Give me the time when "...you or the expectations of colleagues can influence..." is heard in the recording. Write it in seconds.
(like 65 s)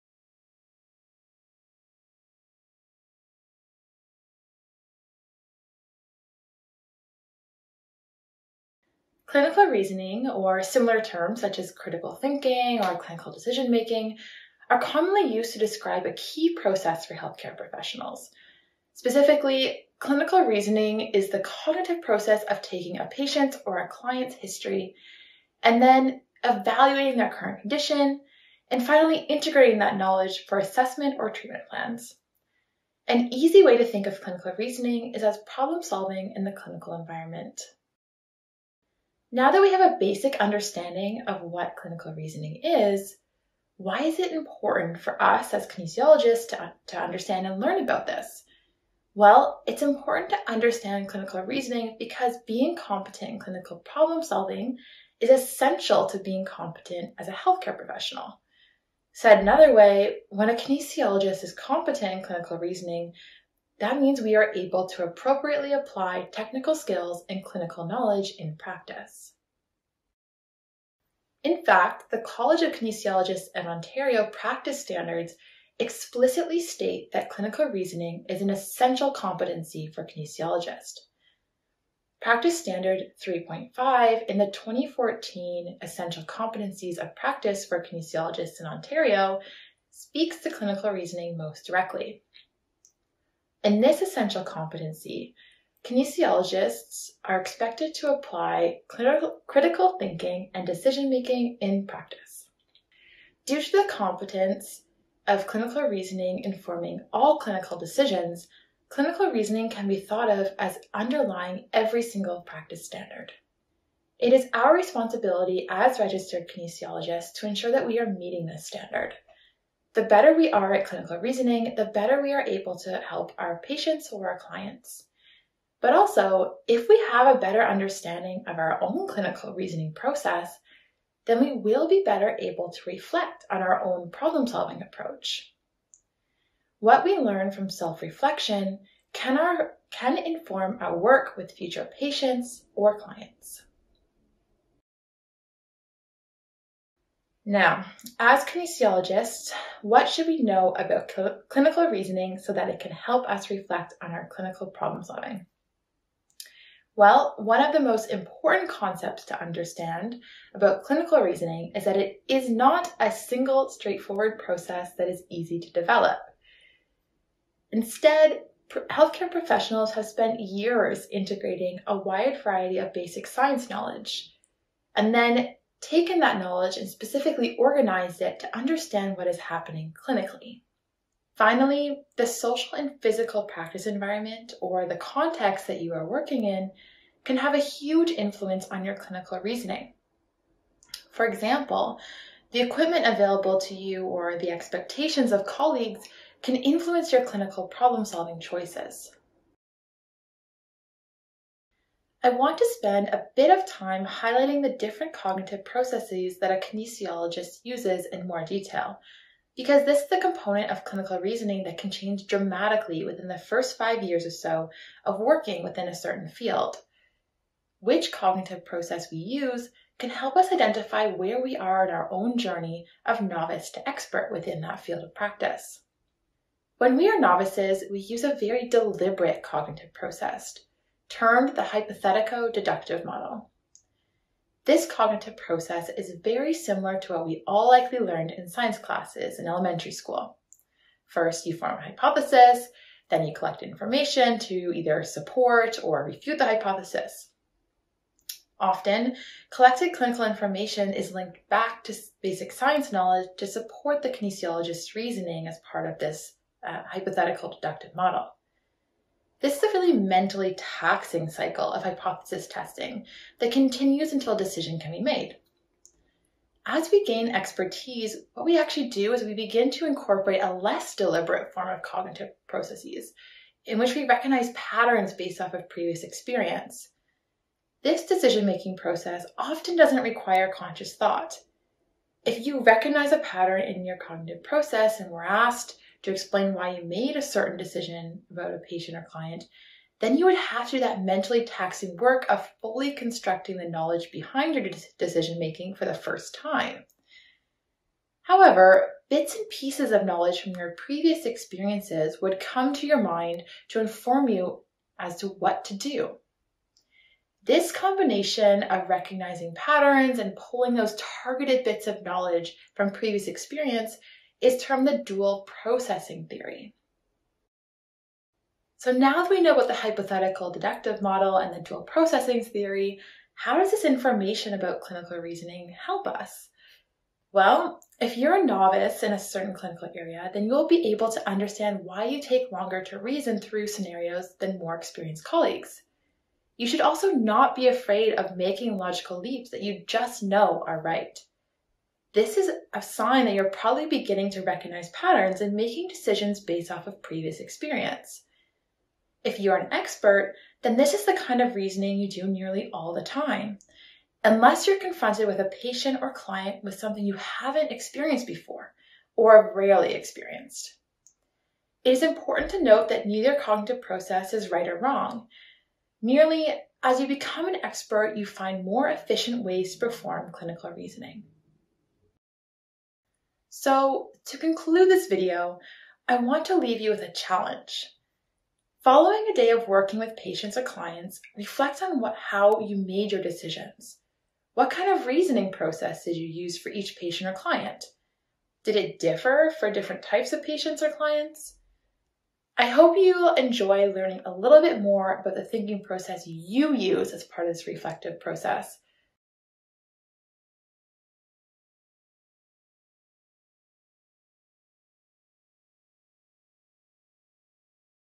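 193 s.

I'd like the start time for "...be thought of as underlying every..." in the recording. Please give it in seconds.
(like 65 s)
109 s.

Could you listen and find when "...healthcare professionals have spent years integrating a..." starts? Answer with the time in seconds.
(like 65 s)
168 s.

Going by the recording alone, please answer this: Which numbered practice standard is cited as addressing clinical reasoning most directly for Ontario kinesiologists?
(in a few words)
3.5.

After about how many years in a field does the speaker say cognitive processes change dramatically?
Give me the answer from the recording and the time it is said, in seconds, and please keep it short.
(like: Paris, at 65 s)
5, at 213 s.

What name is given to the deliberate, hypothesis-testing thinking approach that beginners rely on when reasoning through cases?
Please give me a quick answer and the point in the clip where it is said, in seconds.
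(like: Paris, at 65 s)
hypothetico-deductive model, at 231 s.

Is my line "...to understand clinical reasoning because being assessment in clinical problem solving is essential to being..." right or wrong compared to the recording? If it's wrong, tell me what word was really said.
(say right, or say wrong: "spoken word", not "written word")
wrong: "competent", not "assessment".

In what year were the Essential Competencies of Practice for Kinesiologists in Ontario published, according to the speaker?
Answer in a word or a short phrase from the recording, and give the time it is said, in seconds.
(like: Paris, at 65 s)
2014, at 84 s.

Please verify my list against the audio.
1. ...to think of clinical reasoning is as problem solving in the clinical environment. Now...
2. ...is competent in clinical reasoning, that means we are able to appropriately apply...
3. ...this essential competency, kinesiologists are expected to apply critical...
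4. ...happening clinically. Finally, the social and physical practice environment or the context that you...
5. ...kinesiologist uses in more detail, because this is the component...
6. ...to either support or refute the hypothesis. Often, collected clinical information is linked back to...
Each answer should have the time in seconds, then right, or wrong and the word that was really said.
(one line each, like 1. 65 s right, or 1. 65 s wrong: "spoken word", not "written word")
1. 33 s right
2. 61 s right
3. 93 s right
4. 179 s right
5. 206 s right
6. 244 s right.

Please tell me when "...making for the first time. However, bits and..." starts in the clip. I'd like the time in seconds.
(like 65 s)
295 s.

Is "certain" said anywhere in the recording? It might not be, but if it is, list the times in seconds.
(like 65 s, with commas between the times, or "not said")
215 s, 287 s, 329 s.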